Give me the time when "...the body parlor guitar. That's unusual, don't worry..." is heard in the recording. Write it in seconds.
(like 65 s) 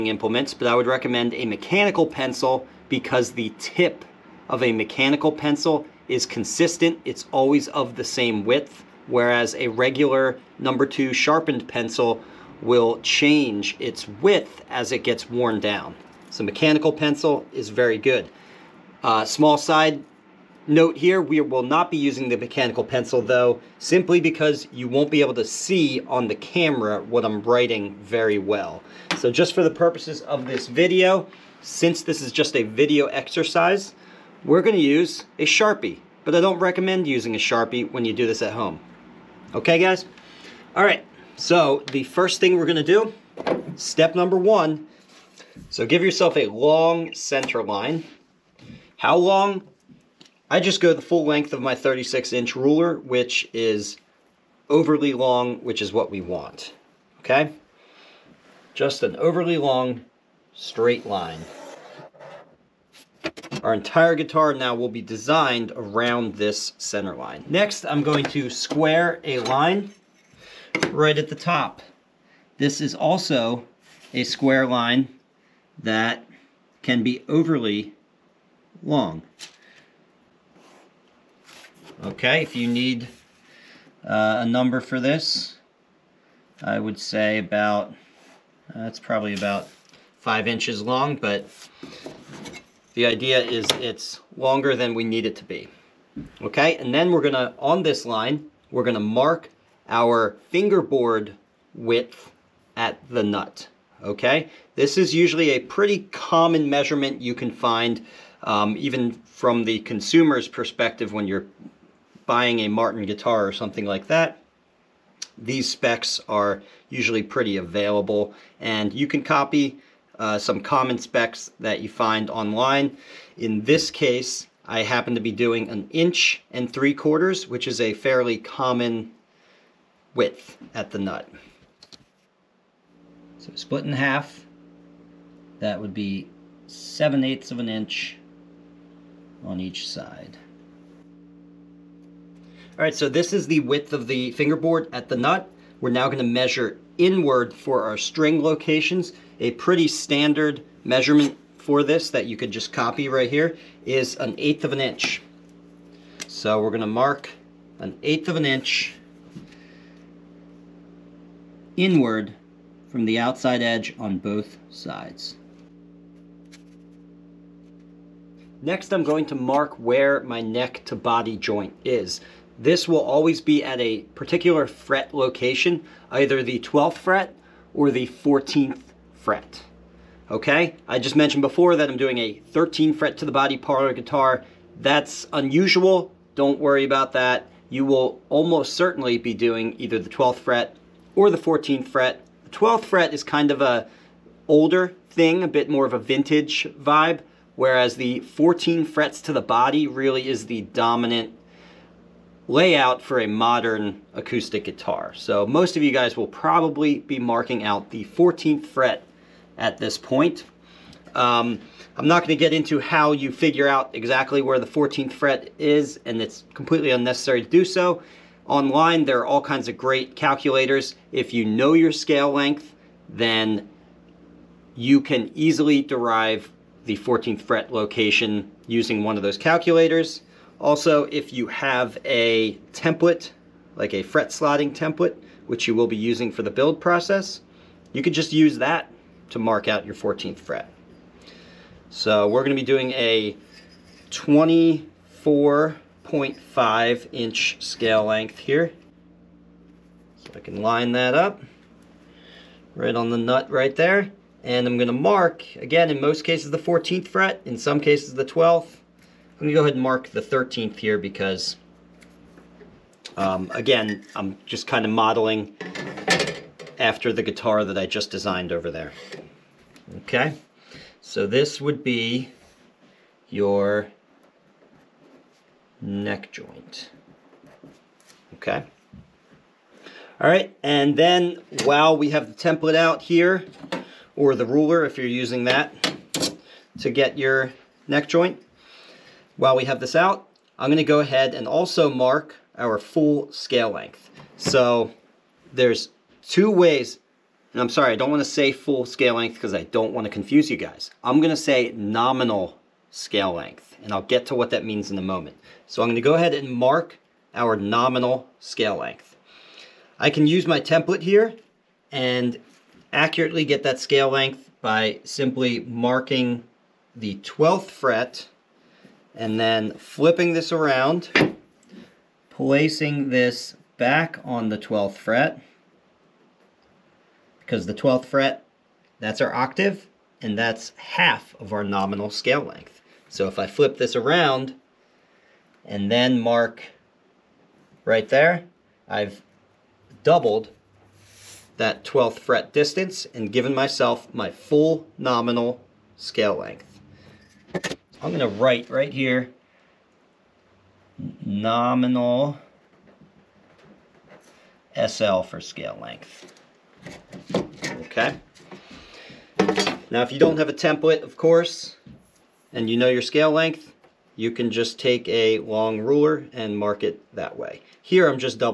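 183 s.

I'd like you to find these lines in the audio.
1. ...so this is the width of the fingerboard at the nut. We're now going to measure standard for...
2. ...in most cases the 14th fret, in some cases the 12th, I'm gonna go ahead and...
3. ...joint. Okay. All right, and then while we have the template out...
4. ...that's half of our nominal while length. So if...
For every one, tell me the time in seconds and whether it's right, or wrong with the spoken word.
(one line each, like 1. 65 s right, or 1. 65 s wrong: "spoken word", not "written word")
1. 142 s wrong: "inward", not "standard"
2. 255 s right
3. 276 s right
4. 330 s wrong: "scale", not "while".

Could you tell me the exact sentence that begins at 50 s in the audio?
I just go the full length of my 36 inch ruler, which is overly long, which is what we want, okay?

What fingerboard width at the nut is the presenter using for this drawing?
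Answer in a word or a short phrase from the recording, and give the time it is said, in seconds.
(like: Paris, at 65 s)
1 3/4 inches, at 125 s.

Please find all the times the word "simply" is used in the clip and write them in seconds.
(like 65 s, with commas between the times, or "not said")
23 s, 315 s.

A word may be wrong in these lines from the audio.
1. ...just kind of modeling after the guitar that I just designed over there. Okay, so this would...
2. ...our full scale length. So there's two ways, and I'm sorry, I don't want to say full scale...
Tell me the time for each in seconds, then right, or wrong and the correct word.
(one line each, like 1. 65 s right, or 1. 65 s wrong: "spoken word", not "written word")
1. 264 s right
2. 292 s right.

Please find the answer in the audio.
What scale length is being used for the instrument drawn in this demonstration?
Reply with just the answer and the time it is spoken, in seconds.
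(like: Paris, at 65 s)
24.5 inch, at 244 s.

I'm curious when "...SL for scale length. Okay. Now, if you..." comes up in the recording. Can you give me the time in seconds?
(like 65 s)
354 s.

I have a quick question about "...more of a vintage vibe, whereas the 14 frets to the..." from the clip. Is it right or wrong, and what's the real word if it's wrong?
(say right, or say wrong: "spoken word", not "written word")
right.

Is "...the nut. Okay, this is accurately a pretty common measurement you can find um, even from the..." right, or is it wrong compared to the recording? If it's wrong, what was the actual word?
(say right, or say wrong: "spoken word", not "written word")
wrong: "usually", not "accurately".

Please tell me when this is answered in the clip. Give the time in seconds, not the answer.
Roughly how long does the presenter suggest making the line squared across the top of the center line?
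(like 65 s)
90 s.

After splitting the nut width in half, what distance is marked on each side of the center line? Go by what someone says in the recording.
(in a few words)
7/8 inch.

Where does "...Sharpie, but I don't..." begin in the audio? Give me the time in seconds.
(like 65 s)
35 s.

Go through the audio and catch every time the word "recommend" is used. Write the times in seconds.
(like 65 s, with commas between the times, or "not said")
0 s, 36 s.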